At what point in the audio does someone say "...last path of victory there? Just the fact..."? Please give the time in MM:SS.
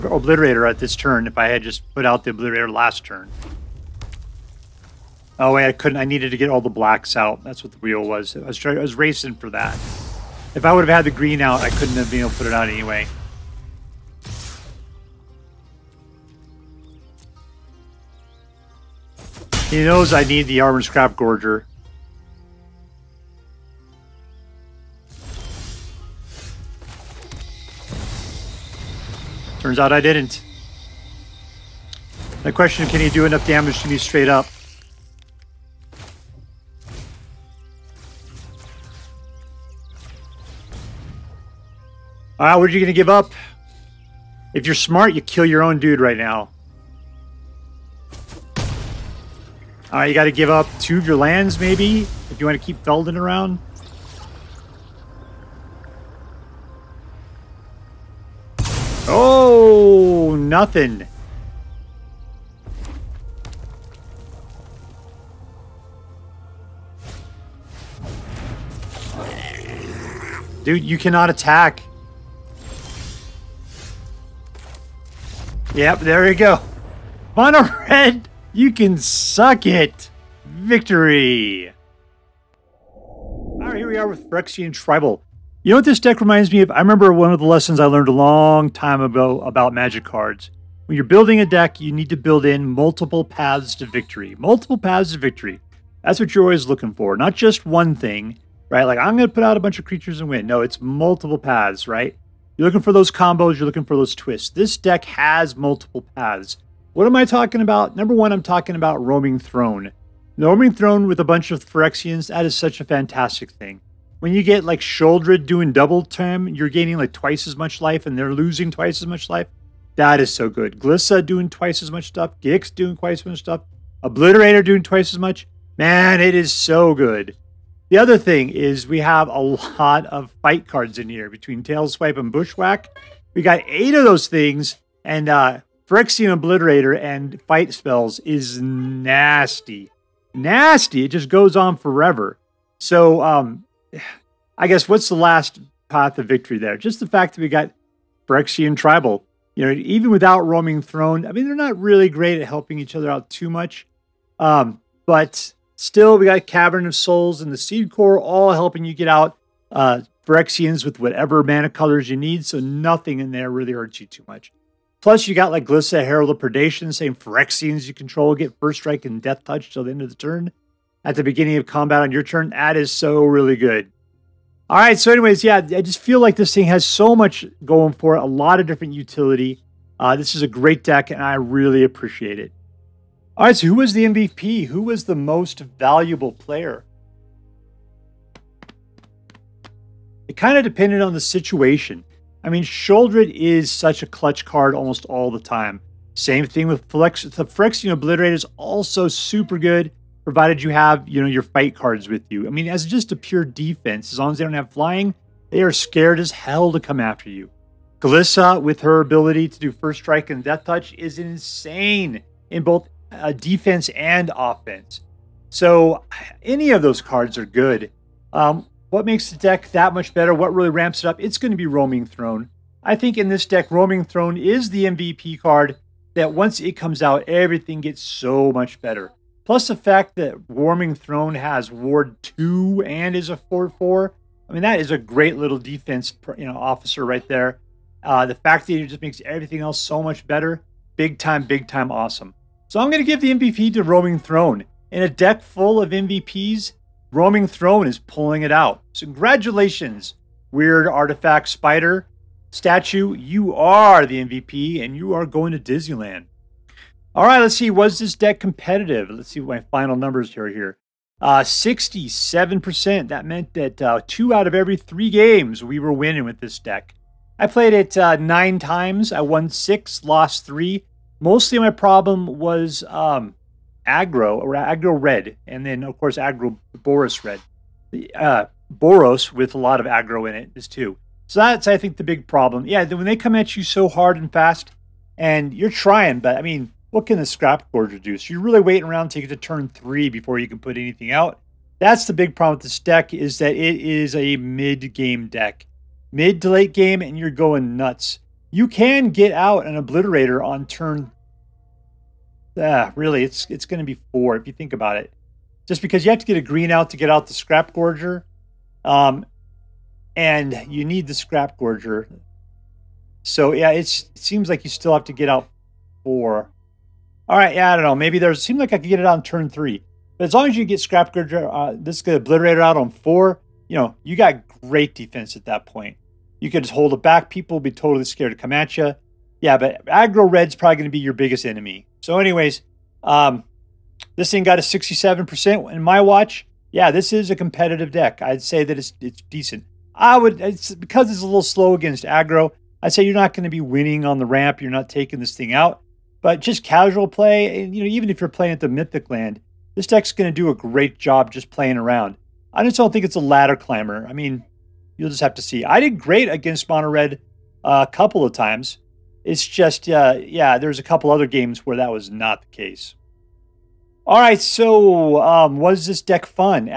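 02:25.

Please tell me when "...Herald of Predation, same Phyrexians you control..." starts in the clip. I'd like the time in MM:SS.
02:46.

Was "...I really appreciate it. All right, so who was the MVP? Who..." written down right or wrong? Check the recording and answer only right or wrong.
right.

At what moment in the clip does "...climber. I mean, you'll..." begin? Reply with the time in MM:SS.
05:53.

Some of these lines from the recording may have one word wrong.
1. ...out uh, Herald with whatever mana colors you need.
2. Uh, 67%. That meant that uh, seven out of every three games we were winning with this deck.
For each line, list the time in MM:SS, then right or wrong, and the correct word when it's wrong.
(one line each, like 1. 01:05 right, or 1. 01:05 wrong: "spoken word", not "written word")
1. 02:39 wrong: "Phyrexians", not "Herald"
2. 04:21 wrong: "two", not "seven".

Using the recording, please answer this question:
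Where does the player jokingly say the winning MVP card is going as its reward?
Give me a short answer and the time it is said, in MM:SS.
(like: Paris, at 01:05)
Disneyland, at 04:15.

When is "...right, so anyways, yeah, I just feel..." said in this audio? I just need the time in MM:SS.
02:54.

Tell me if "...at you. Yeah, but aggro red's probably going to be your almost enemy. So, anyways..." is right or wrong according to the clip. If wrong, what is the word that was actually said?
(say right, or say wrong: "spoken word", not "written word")
wrong: "biggest", not "almost".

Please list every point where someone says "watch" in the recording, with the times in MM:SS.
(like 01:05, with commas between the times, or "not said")
05:36.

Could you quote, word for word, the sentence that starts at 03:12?
I mean, Sheoldred is such a clutch card almost all the time.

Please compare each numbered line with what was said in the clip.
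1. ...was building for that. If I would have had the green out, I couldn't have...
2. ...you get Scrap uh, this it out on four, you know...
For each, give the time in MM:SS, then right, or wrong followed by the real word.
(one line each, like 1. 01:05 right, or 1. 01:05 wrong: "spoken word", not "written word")
1. 00:08 wrong: "racing", not "building"
2. 05:20 right.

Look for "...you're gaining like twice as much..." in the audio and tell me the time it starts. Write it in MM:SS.
01:56.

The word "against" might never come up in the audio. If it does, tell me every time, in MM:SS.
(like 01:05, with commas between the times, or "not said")
05:41, 05:56.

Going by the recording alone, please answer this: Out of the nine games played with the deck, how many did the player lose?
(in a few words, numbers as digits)
3.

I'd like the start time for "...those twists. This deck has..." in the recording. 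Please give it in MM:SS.
01:43.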